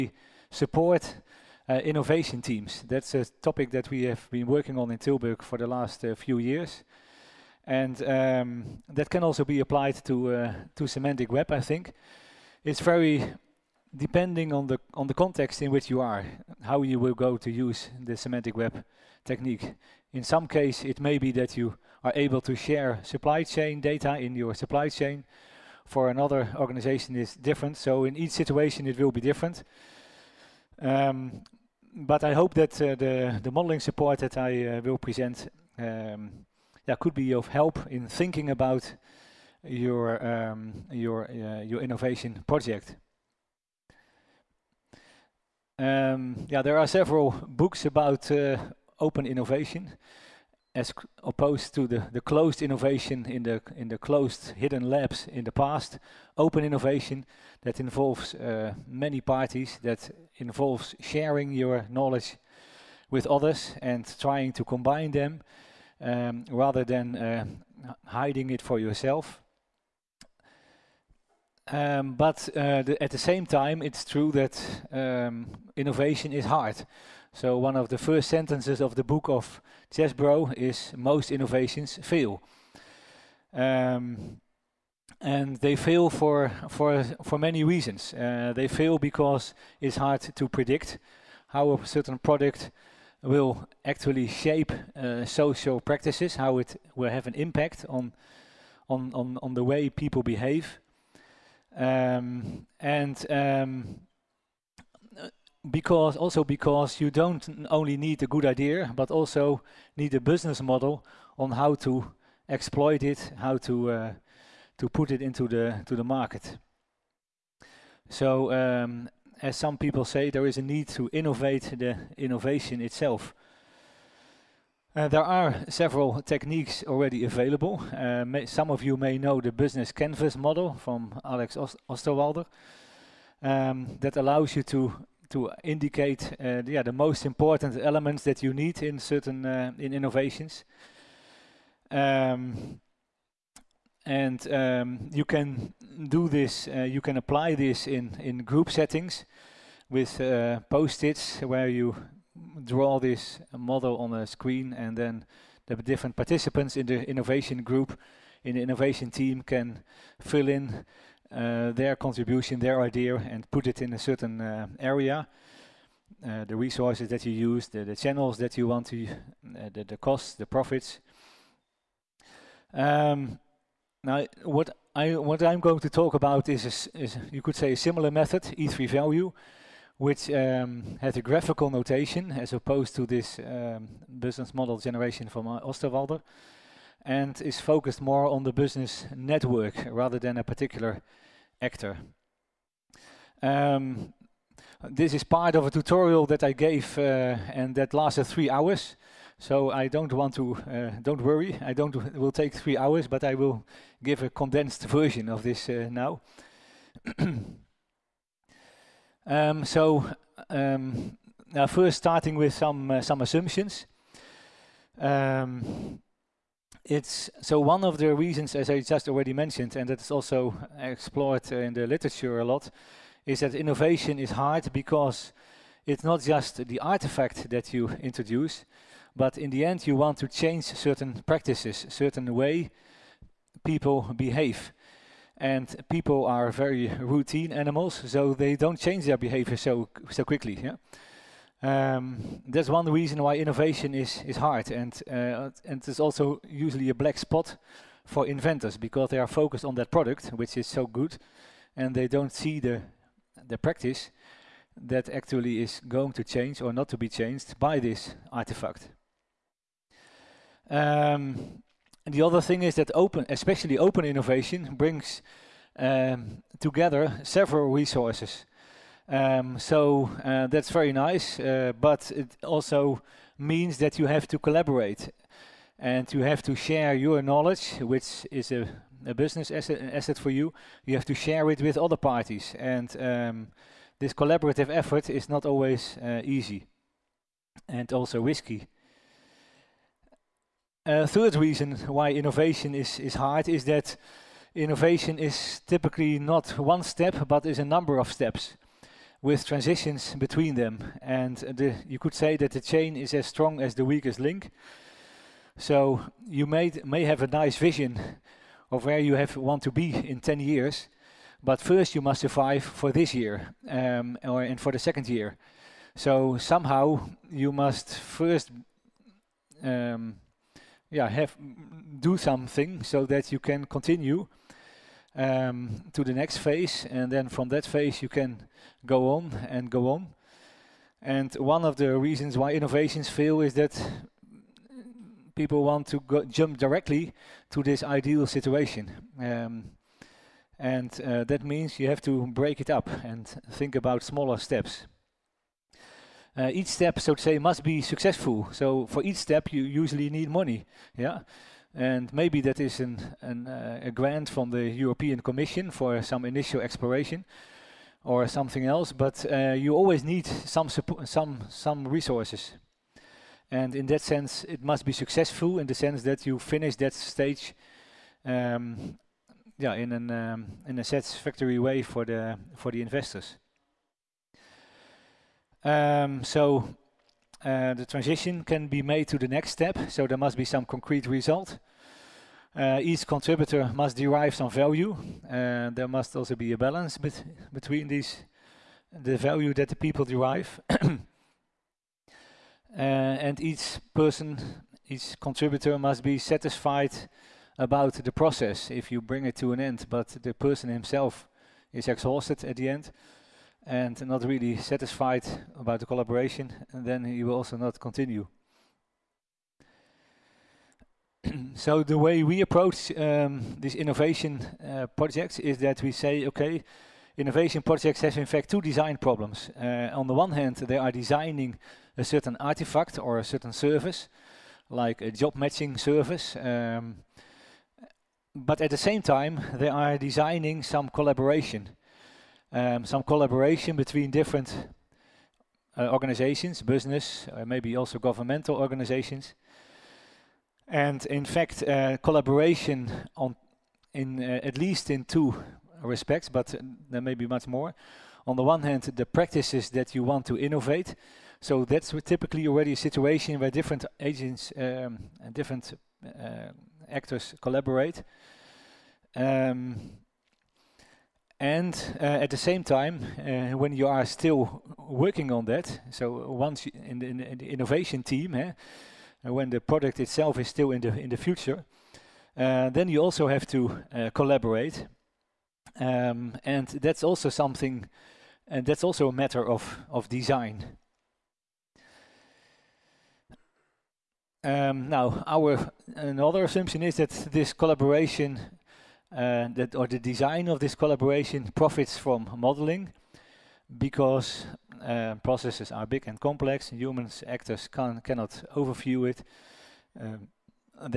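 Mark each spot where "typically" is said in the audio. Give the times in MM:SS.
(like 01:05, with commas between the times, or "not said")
04:55, 07:32.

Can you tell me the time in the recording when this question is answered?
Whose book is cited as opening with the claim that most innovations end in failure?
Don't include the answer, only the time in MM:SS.
01:19.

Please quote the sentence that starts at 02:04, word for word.
Uh, there are several techniques already available.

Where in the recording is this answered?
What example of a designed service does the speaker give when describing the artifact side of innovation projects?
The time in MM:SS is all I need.
07:05.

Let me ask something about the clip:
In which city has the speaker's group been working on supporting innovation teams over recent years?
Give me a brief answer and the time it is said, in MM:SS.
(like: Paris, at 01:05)
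Tilburg, at 00:04.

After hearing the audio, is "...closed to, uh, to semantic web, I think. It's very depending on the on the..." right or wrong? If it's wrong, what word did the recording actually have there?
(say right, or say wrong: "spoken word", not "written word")
wrong: "applied", not "closed".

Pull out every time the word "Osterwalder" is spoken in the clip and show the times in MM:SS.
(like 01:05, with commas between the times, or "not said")
02:11, 03:05.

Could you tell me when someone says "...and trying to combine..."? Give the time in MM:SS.
01:03.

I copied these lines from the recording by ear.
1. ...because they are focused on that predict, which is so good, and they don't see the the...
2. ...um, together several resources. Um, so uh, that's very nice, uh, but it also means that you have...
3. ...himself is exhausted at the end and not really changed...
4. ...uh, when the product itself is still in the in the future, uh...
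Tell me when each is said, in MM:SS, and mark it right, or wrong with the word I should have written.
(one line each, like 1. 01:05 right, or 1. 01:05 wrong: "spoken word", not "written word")
1. 04:08 wrong: "product", not "predict"
2. 04:25 right
3. 06:40 wrong: "satisfied", not "changed"
4. 07:49 right.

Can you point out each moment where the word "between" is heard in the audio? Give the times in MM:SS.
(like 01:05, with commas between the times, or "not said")
05:00, 06:27, 07:13.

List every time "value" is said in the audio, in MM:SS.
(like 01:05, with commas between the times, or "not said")
02:58, 06:24, 06:29.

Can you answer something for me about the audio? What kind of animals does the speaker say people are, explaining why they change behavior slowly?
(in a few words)
routine animals.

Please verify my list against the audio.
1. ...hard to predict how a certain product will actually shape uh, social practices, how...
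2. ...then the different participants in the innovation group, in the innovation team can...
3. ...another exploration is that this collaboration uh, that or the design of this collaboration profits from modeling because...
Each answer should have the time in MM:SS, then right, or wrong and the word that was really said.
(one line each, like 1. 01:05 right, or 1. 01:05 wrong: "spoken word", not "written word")
1. 01:29 right
2. 02:34 right
3. 08:05 wrong: "assumption", not "exploration".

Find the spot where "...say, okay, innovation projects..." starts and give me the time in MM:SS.
06:55.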